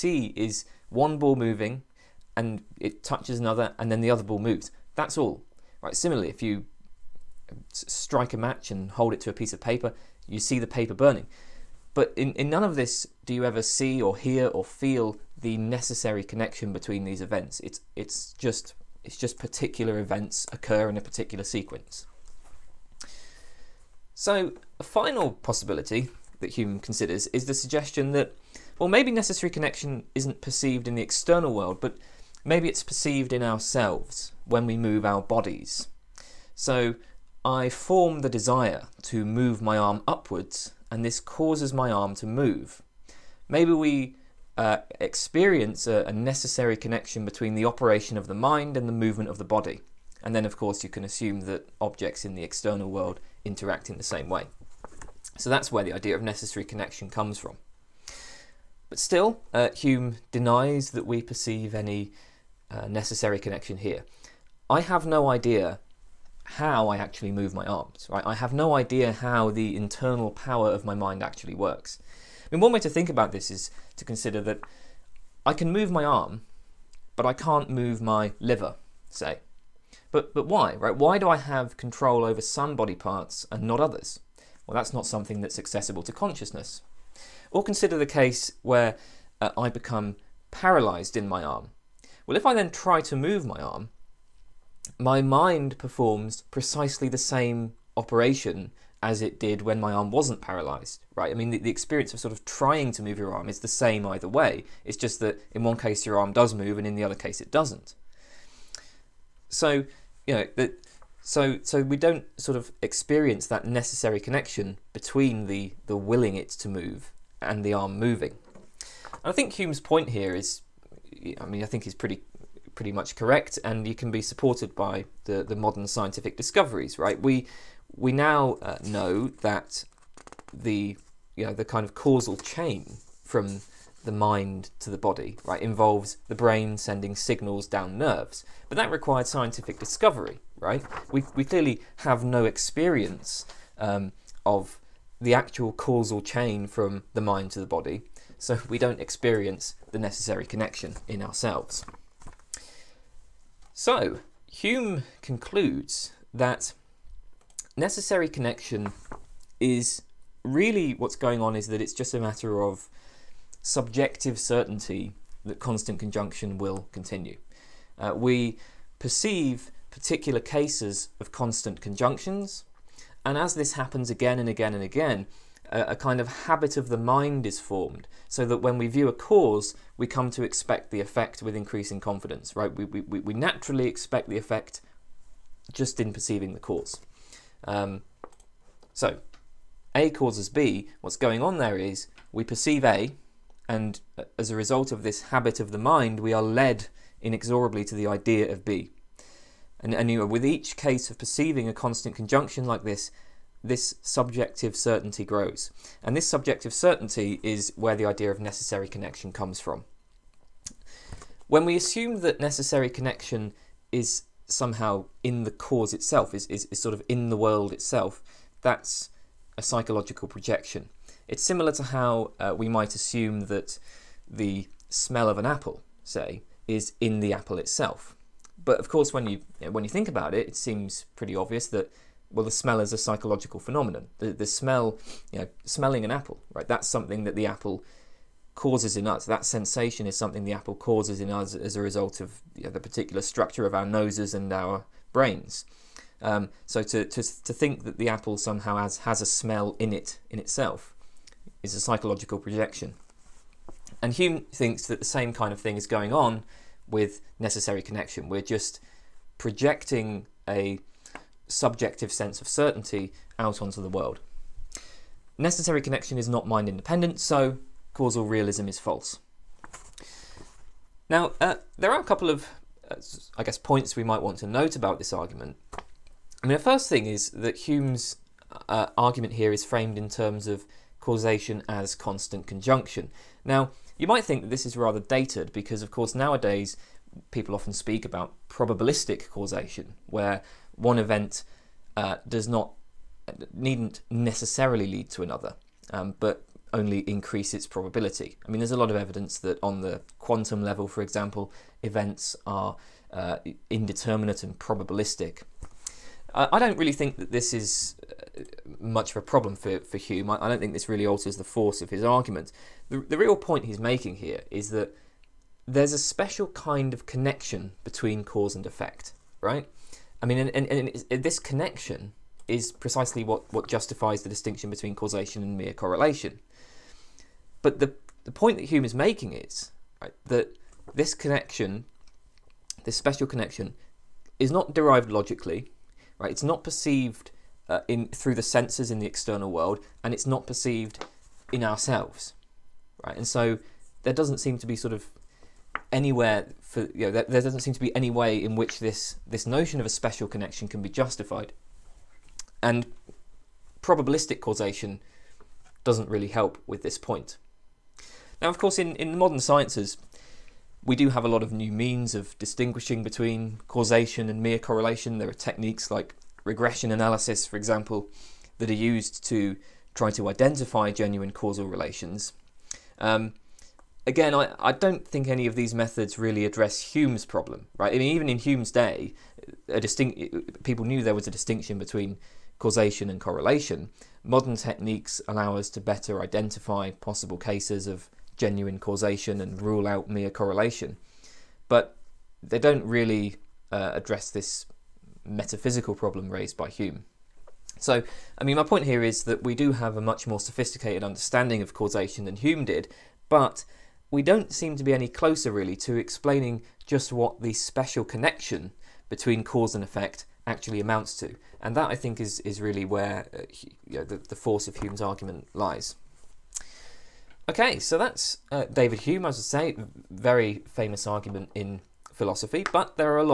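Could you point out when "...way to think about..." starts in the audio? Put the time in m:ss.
1:12.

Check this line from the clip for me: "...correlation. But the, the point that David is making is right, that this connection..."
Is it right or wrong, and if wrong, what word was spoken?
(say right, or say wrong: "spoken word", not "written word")
wrong: "Hume", not "David".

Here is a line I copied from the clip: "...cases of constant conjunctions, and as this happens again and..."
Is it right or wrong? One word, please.
right.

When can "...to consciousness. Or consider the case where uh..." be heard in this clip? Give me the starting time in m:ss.
1:26.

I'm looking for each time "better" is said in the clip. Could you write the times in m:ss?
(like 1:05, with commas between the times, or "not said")
6:25.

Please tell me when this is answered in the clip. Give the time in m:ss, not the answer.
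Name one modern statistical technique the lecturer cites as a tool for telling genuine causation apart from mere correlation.
6:06.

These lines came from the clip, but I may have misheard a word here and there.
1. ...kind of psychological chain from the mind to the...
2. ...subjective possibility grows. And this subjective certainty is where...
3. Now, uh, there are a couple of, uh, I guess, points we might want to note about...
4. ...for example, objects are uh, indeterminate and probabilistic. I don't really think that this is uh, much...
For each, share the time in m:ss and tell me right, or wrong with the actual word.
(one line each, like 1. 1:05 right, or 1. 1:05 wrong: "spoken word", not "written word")
1. 2:11 wrong: "causal", not "psychological"
2. 3:24 wrong: "certainty", not "possibility"
3. 4:31 right
4. 5:00 wrong: "events", not "objects".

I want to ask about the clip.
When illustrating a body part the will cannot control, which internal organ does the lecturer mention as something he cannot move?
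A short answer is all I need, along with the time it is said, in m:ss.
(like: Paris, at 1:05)
liver, at 1:18.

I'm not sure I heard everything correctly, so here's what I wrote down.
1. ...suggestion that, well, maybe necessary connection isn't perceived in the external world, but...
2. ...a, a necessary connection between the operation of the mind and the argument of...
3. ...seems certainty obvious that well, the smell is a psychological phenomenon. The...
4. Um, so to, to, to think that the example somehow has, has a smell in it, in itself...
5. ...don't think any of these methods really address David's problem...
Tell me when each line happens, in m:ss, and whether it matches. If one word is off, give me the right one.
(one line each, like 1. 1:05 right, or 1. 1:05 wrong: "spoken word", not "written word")
1. 0:27 right
2. 0:45 wrong: "movement", not "argument"
3. 3:50 wrong: "pretty", not "certainty"
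4. 4:06 wrong: "apple", not "example"
5. 6:14 wrong: "Hume", not "David".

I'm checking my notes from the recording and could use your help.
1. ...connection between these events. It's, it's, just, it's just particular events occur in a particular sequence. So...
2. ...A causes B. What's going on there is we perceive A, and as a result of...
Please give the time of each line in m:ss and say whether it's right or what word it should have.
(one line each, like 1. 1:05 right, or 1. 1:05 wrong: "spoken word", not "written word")
1. 0:16 right
2. 3:09 right.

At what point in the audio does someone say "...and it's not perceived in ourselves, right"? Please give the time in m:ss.
5:40.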